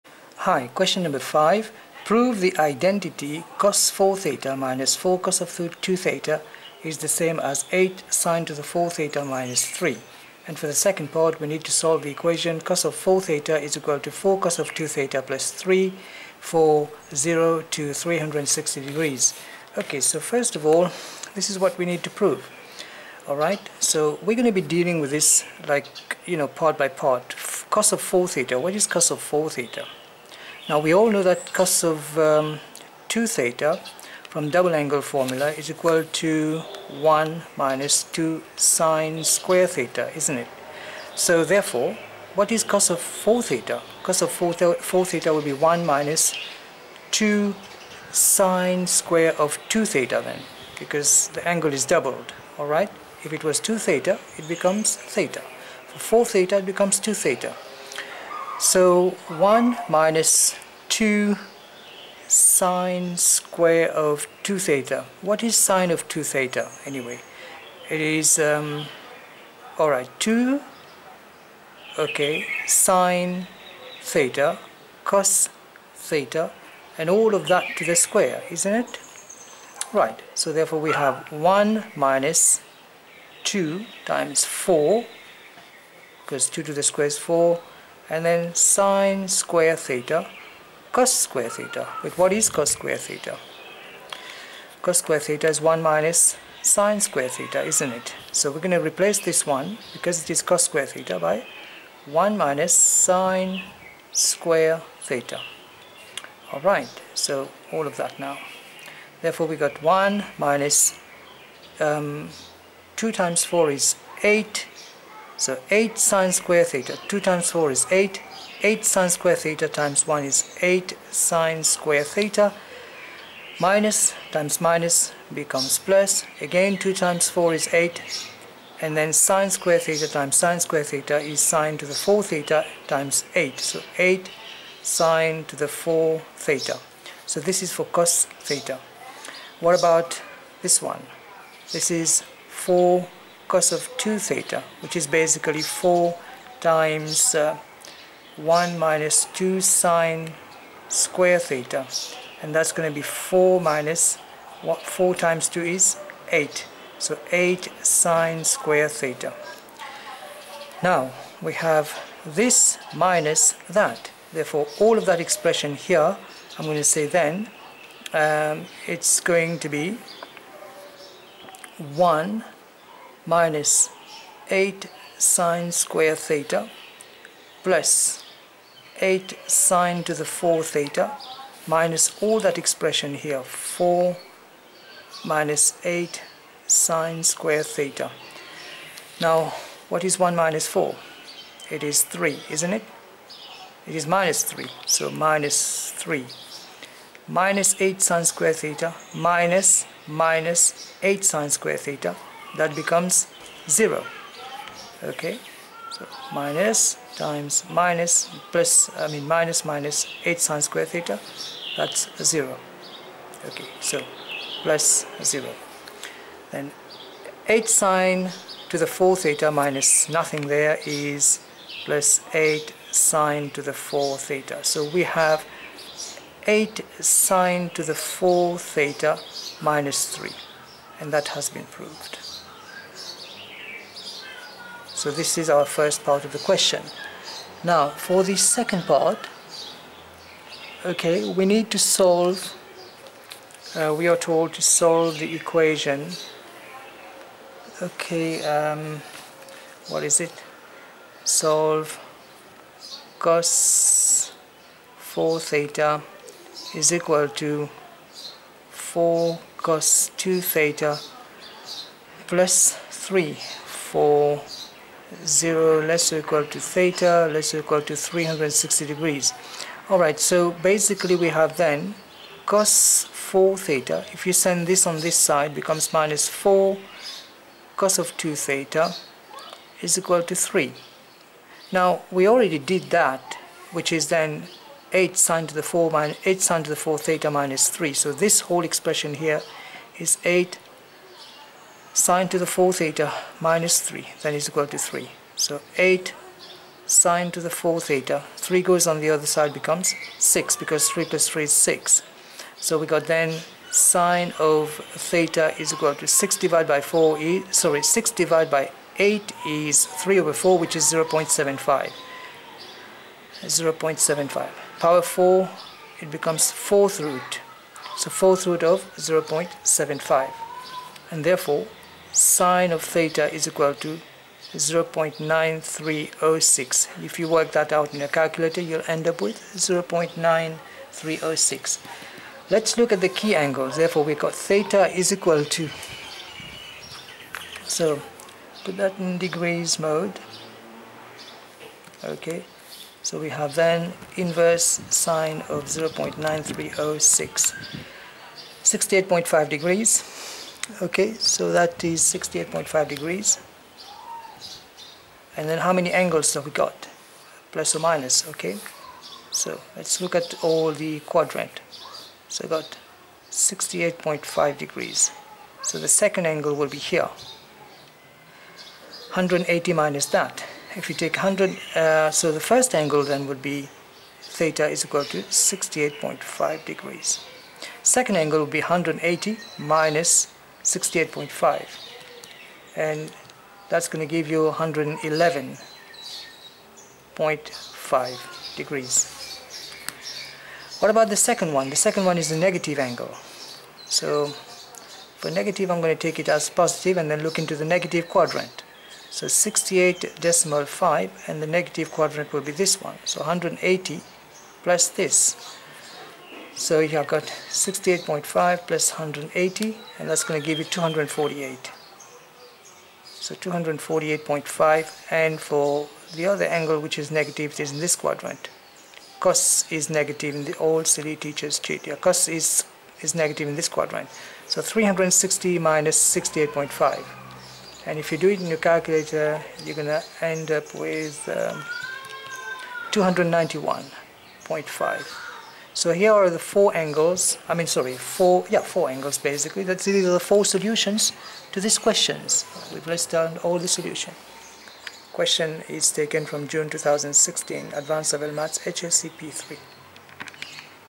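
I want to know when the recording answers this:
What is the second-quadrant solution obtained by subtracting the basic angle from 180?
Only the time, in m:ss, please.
6:24.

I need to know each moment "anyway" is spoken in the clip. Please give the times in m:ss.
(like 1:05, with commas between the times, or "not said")
1:06.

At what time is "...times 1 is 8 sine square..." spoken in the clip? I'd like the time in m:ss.
1:59.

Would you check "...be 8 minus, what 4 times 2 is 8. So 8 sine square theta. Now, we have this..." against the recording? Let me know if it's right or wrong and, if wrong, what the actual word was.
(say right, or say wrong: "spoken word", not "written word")
wrong: "4", not "8".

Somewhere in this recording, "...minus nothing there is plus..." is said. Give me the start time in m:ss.
3:39.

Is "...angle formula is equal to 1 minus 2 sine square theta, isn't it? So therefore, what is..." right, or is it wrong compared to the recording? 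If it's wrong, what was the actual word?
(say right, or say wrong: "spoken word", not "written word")
right.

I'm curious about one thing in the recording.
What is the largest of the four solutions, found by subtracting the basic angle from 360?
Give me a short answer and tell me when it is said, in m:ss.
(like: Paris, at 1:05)
291.5, at 7:12.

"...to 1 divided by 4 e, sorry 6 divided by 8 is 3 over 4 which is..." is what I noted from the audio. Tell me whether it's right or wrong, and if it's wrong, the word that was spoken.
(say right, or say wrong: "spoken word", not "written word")
wrong: "6", not "1".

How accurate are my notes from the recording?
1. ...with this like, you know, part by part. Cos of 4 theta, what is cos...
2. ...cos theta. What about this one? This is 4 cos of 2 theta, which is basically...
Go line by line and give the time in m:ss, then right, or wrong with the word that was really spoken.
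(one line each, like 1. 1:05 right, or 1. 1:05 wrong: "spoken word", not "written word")
1. 0:25 right
2. 2:17 right.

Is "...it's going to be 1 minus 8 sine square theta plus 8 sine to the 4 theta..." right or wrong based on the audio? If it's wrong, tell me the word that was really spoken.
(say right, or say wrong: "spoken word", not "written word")
right.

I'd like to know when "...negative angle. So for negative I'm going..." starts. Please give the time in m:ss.
6:32.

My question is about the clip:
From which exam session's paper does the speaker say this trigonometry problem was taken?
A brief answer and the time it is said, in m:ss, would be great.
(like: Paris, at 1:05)
June 2016, at 7:26.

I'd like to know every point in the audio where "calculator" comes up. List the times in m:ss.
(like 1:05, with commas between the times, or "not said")
5:28, 7:08.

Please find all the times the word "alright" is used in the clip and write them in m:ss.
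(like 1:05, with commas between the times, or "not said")
0:23, 0:52, 1:09, 1:46, 4:29.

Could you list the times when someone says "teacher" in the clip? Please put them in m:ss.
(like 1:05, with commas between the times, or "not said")
7:01.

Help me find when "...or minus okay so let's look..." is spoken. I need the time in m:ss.
5:57.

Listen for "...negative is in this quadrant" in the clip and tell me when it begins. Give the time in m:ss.
6:57.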